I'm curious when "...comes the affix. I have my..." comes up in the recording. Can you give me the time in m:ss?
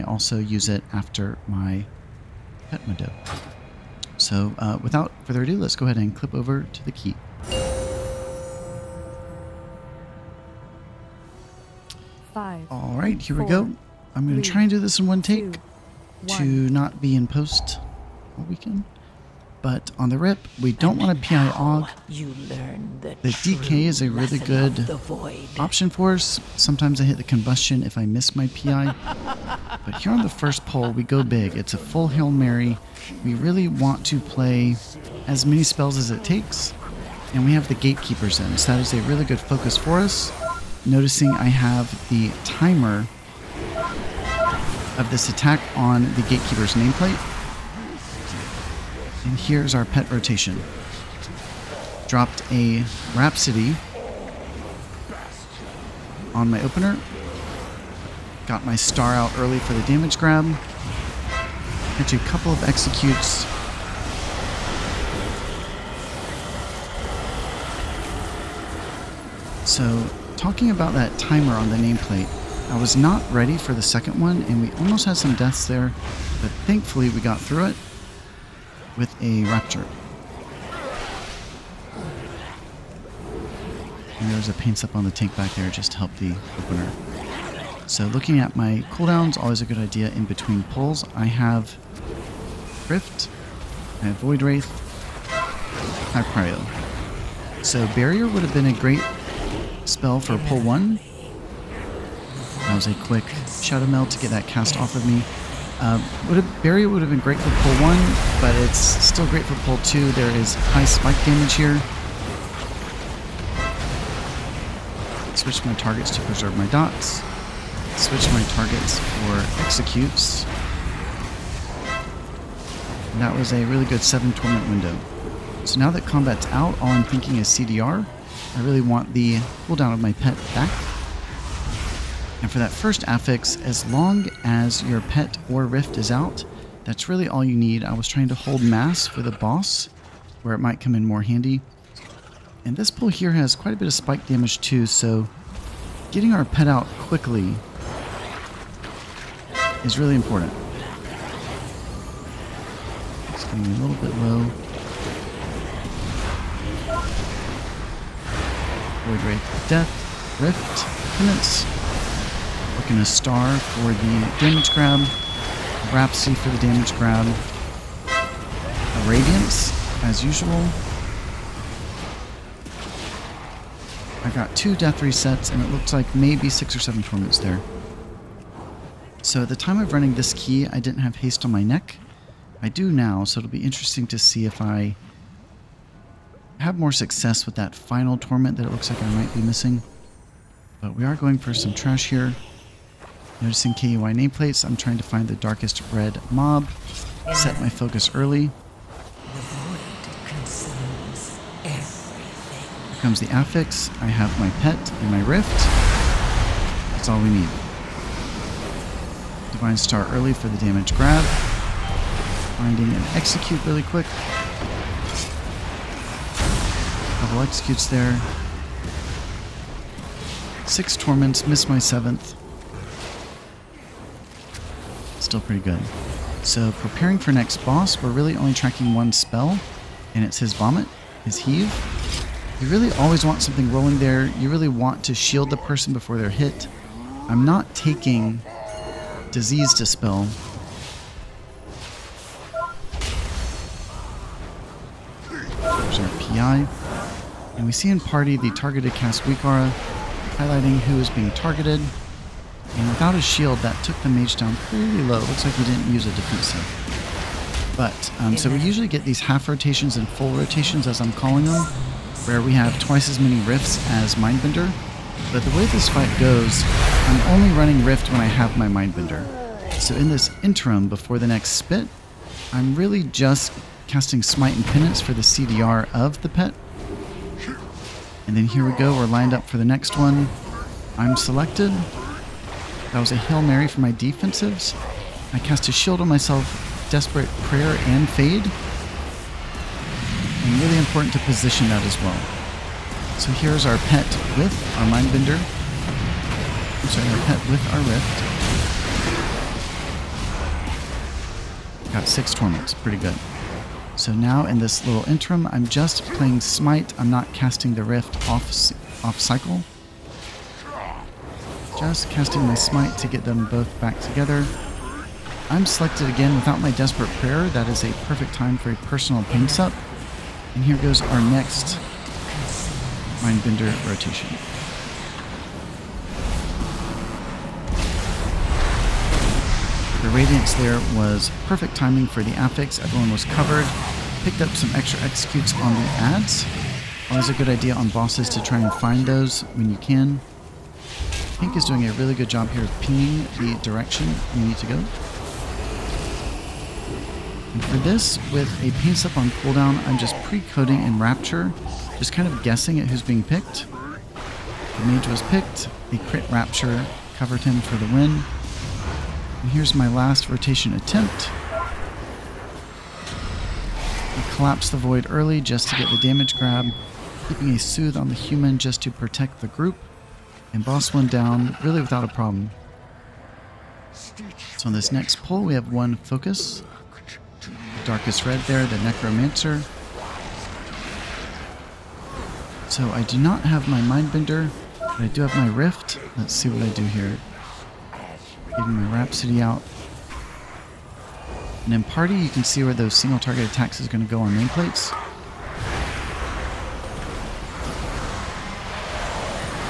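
3:23.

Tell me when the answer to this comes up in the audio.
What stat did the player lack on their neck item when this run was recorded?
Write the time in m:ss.
3:01.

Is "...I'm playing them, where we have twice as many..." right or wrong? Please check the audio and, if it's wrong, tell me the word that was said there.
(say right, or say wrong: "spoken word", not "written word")
wrong: "calling", not "playing".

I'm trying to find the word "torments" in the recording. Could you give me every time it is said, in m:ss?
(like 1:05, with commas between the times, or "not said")
2:04, 2:57, 3:08, 3:40, 5:02.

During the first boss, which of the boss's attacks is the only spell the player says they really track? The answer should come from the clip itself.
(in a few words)
Heave.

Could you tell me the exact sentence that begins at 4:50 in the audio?
And really important to position that as well.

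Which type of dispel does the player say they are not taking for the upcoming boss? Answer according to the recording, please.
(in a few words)
Disease Dispel.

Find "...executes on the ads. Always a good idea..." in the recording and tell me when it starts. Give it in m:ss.
5:35.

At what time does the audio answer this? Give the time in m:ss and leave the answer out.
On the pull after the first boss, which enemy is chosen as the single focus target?
6:18.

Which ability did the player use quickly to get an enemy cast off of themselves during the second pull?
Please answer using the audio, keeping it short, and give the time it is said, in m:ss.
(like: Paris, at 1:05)
Shadowmeld, at 1:43.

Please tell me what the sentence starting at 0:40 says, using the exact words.
Noticing I have the timer of this attack on the gatekeeper's nameplate and here's our pet rotation.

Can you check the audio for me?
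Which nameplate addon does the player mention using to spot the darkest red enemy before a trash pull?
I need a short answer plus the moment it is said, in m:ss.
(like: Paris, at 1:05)
KUI, at 3:13.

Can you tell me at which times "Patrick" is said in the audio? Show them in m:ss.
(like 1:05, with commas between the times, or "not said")
not said.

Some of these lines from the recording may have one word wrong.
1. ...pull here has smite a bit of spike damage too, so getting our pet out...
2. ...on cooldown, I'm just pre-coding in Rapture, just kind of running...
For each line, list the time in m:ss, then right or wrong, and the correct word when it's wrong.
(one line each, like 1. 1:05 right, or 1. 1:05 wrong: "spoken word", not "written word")
1. 2:22 wrong: "quite", not "smite"
2. 5:49 wrong: "guessing", not "running".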